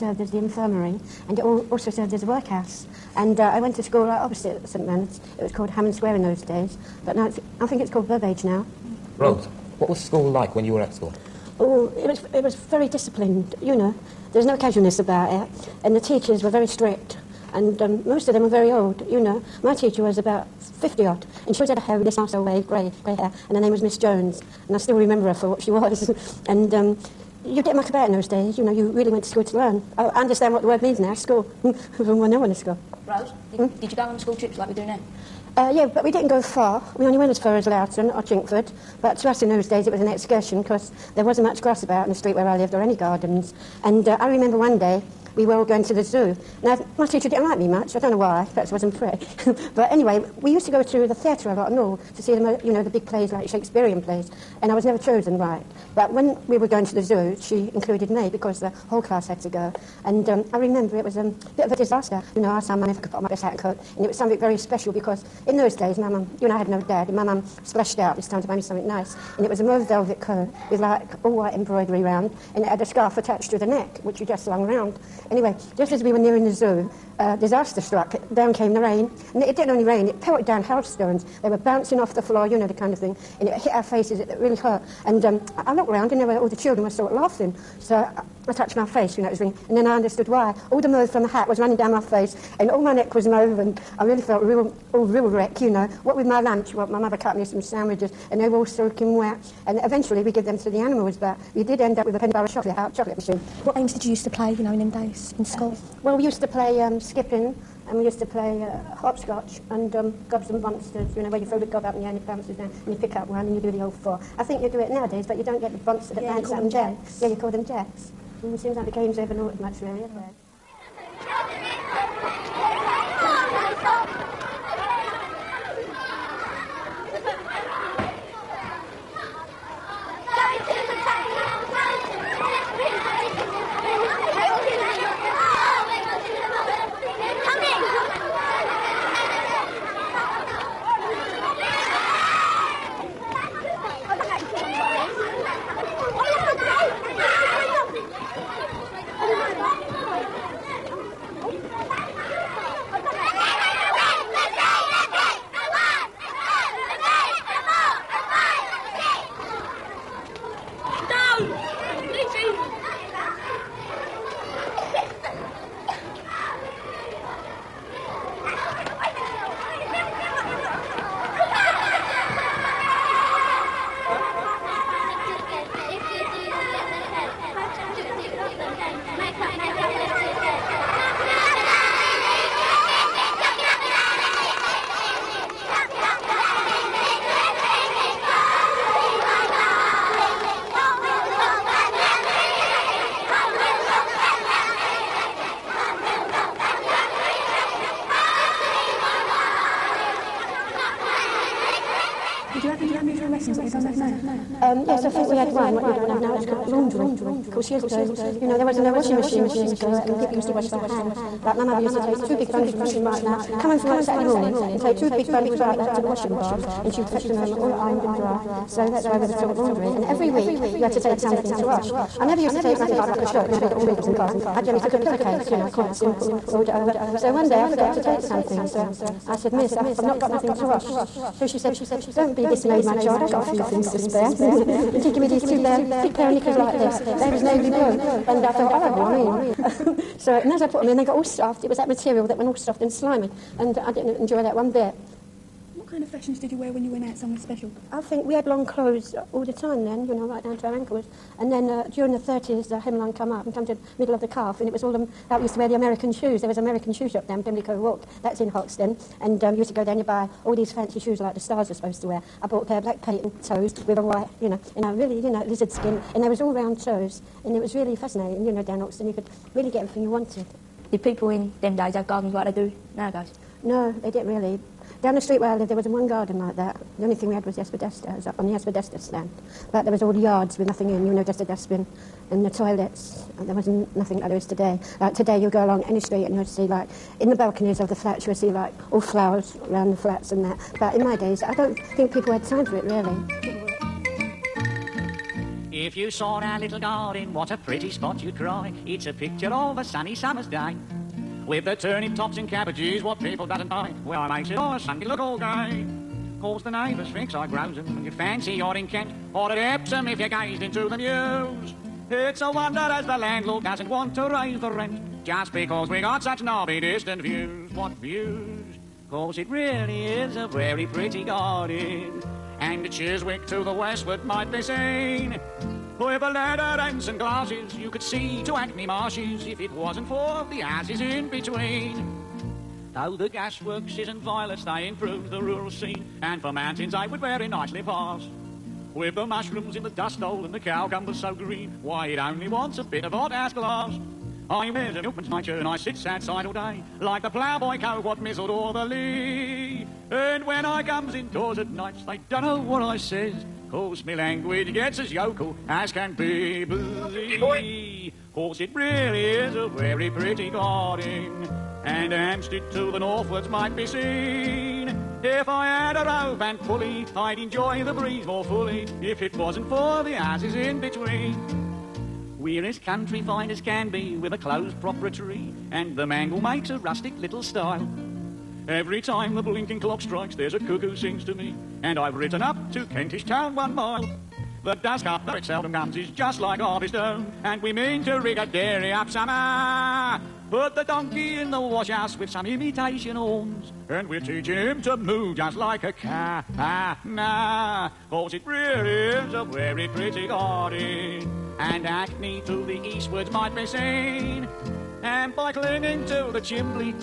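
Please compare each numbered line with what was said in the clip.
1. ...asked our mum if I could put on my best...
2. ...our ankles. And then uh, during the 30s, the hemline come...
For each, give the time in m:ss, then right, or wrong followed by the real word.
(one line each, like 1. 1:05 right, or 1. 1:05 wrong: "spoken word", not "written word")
1. 1:02 right
2. 4:10 right.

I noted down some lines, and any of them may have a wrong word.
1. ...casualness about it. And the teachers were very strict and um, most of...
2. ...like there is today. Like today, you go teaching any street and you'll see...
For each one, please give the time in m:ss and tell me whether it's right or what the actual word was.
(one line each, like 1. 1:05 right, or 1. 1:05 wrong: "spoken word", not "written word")
1. 0:14 right
2. 4:44 wrong: "along", not "teaching".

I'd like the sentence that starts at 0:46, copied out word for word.
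Now, my teacher didn't like me much.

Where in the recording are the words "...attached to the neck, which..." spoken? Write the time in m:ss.
1:13.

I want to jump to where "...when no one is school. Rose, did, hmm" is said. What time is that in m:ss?
0:32.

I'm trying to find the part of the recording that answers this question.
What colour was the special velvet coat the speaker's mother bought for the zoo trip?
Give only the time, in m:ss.
1:09.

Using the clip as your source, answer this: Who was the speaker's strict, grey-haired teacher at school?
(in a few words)
Miss Jones.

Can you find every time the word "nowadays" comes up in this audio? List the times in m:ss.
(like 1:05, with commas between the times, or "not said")
1:54, 4:32.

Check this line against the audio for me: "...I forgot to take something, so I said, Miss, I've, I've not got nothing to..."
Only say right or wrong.
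right.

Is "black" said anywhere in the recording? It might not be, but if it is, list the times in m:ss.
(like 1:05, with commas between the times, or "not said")
4:22.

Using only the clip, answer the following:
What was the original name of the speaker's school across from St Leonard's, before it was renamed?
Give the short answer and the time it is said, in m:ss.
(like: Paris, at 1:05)
Hammond Square, at 0:05.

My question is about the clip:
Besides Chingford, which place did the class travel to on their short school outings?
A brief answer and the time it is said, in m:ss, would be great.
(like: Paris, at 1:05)
Loughton, at 0:37.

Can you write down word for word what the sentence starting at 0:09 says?
Rose, what was school like when you were at school?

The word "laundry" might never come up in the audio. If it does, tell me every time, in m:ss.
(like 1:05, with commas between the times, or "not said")
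3:26, 3:39.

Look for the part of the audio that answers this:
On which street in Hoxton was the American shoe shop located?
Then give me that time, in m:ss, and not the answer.
4:17.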